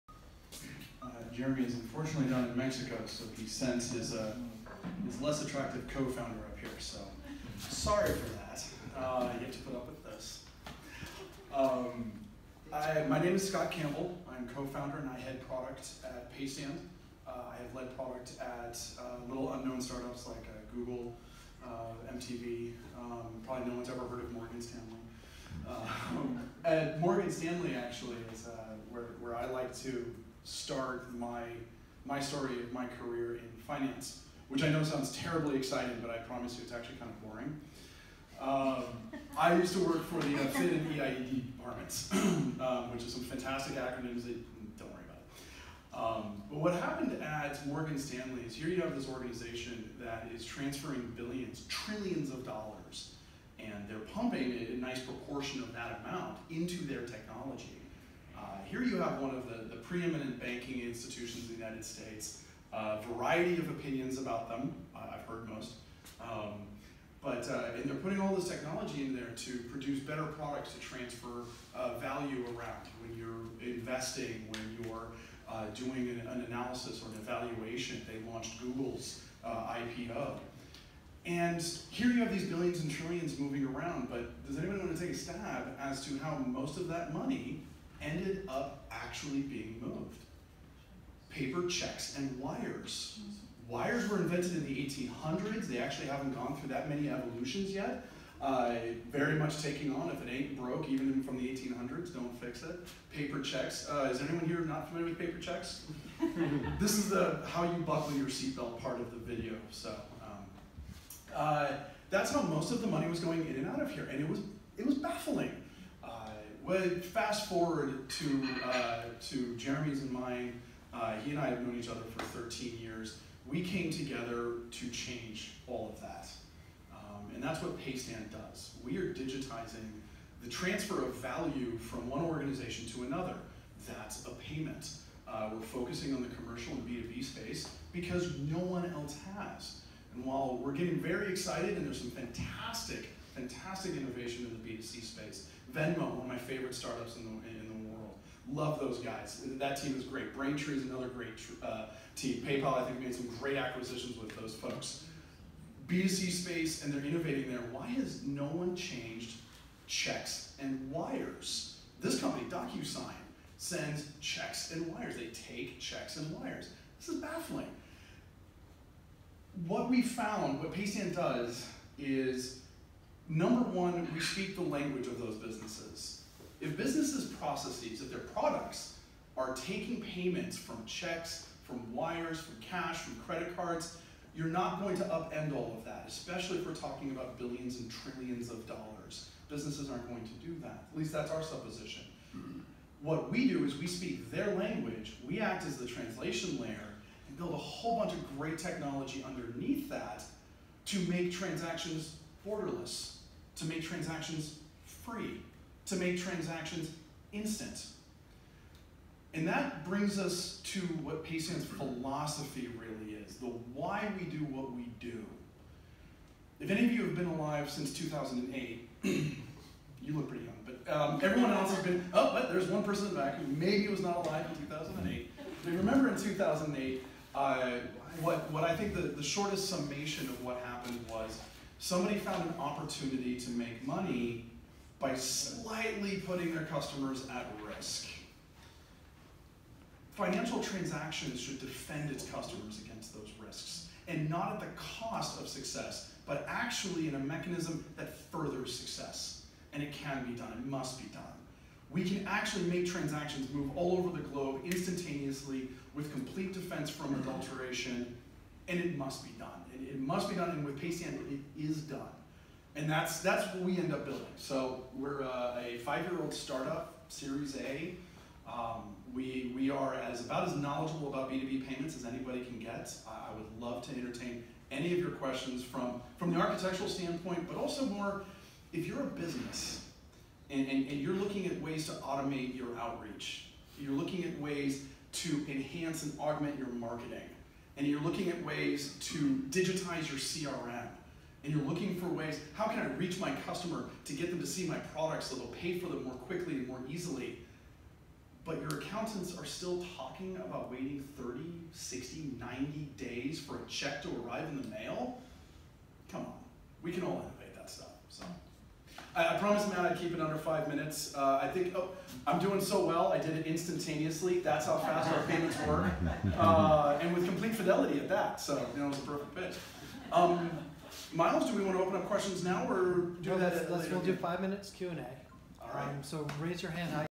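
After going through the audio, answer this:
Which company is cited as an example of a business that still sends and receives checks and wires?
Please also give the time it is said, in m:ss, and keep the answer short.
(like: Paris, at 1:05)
DocuSign, at 2:42.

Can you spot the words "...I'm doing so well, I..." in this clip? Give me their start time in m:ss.
5:12.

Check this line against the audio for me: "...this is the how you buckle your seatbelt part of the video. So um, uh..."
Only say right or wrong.
right.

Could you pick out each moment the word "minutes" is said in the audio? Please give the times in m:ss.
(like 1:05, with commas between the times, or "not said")
5:10, 5:24.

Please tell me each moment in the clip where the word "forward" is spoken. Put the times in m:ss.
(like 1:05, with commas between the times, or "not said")
1:57.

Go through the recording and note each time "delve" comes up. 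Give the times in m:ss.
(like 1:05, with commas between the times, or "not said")
not said.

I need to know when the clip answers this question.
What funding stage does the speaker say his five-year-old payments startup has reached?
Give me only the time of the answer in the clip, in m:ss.
4:27.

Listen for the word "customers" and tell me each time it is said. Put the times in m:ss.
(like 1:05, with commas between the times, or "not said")
3:56, 4:02, 4:53.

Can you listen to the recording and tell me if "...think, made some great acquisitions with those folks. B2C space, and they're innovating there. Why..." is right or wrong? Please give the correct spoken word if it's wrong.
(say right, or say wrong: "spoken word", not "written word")
right.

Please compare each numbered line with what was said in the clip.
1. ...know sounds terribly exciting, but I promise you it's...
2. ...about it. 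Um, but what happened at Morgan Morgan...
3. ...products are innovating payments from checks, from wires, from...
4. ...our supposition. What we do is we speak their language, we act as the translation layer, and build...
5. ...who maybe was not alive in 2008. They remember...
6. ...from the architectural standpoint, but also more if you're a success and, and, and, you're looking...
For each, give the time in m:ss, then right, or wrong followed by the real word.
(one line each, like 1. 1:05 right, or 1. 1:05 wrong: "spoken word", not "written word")
1. 0:34 right
2. 0:45 wrong: "Stanley", not "Morgan"
3. 2:58 wrong: "taking", not "innovating"
4. 3:11 right
5. 3:43 right
6. 4:36 wrong: "business", not "success".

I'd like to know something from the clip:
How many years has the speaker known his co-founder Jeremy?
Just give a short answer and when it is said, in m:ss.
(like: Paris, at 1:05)
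13, at 2:02.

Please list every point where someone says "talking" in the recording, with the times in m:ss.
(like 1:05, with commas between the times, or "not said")
3:06, 4:59.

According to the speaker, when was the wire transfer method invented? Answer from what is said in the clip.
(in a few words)
1800s.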